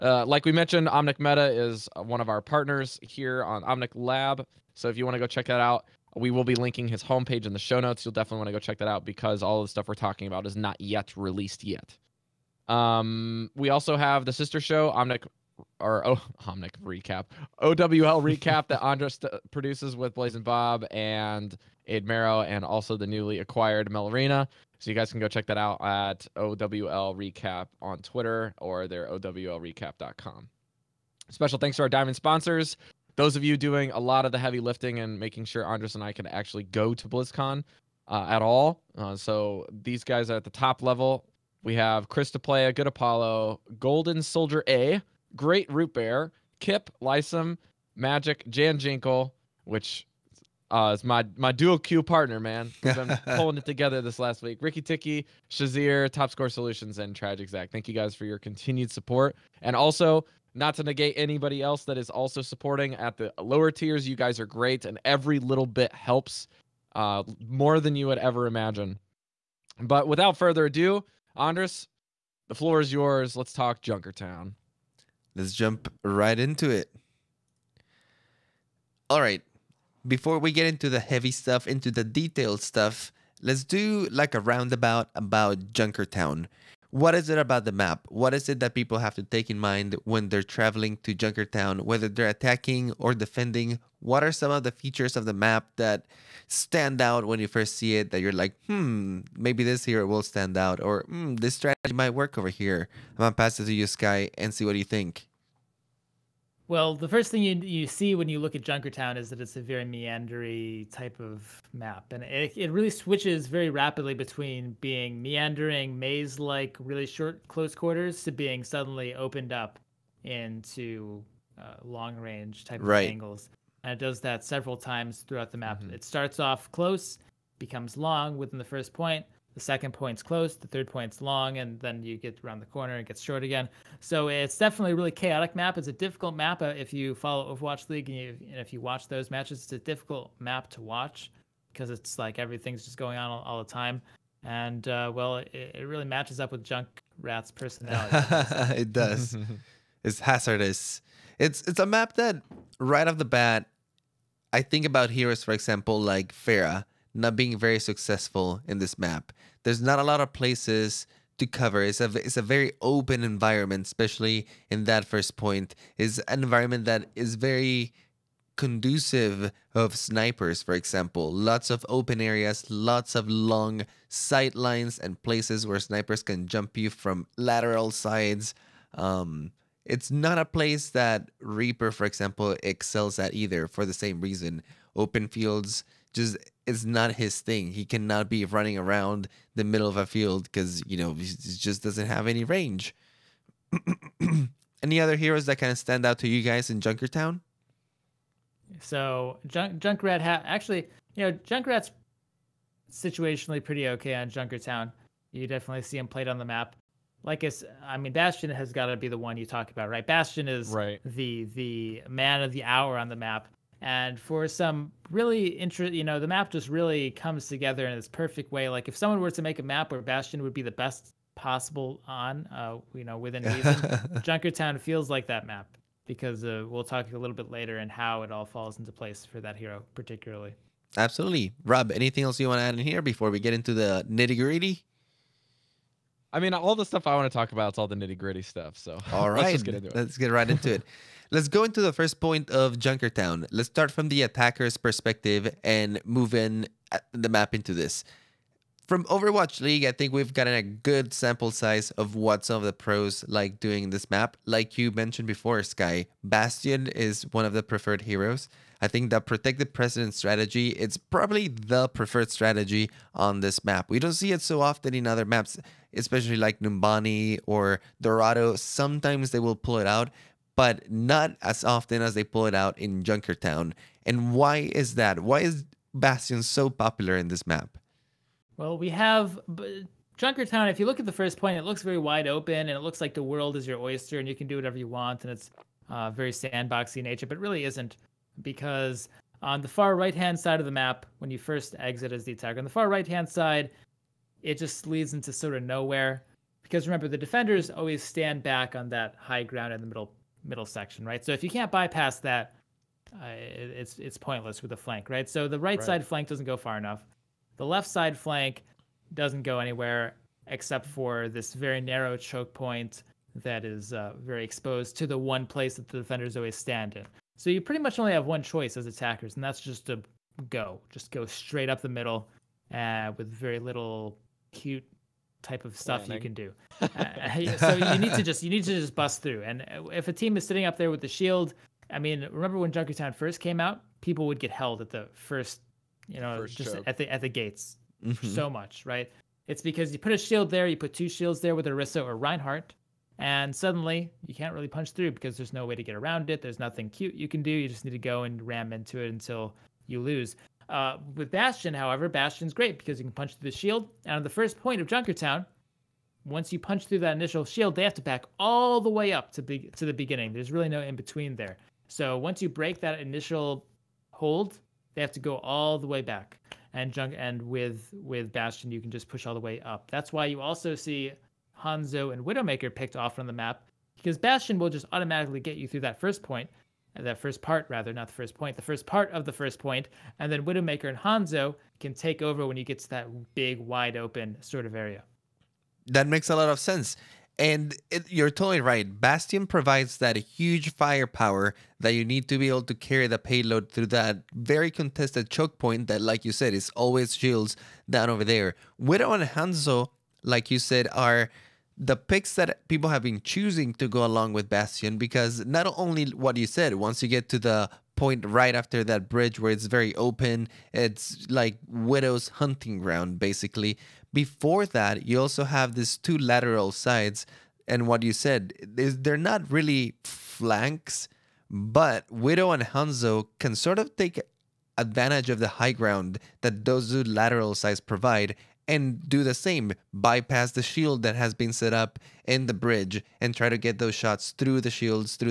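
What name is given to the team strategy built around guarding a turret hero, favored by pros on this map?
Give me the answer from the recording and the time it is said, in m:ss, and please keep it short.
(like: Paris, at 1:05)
protected president, at 4:19.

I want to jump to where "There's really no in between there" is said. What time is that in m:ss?
6:00.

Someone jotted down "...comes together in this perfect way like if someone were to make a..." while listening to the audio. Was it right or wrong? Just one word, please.
right.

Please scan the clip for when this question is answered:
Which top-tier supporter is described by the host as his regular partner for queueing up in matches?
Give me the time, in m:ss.
0:48.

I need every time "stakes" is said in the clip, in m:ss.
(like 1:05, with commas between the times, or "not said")
not said.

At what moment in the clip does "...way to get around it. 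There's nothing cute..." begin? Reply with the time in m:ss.
5:45.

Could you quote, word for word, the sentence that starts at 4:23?
We don't see it so often in other maps, especially like Numbani or Dorado.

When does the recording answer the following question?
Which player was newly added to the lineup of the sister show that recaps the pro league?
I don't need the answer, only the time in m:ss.
0:23.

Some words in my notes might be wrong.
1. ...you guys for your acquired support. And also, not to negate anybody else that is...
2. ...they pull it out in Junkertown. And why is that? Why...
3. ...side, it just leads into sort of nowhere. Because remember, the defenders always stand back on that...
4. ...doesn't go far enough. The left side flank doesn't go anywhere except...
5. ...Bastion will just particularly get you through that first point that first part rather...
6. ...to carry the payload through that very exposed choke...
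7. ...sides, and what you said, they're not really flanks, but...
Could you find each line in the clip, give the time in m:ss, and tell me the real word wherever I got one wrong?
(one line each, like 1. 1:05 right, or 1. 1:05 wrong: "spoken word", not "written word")
1. 0:57 wrong: "continued", not "acquired"
2. 4:32 right
3. 4:53 right
4. 5:06 right
5. 6:14 wrong: "automatically", not "particularly"
6. 6:32 wrong: "contested", not "exposed"
7. 6:56 right.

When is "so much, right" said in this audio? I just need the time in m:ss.
5:38.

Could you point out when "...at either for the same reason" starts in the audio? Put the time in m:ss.
3:03.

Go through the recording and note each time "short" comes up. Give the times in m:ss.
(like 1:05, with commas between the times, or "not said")
1:57, 2:13.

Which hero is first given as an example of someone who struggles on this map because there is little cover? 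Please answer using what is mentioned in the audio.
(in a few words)
Pharah.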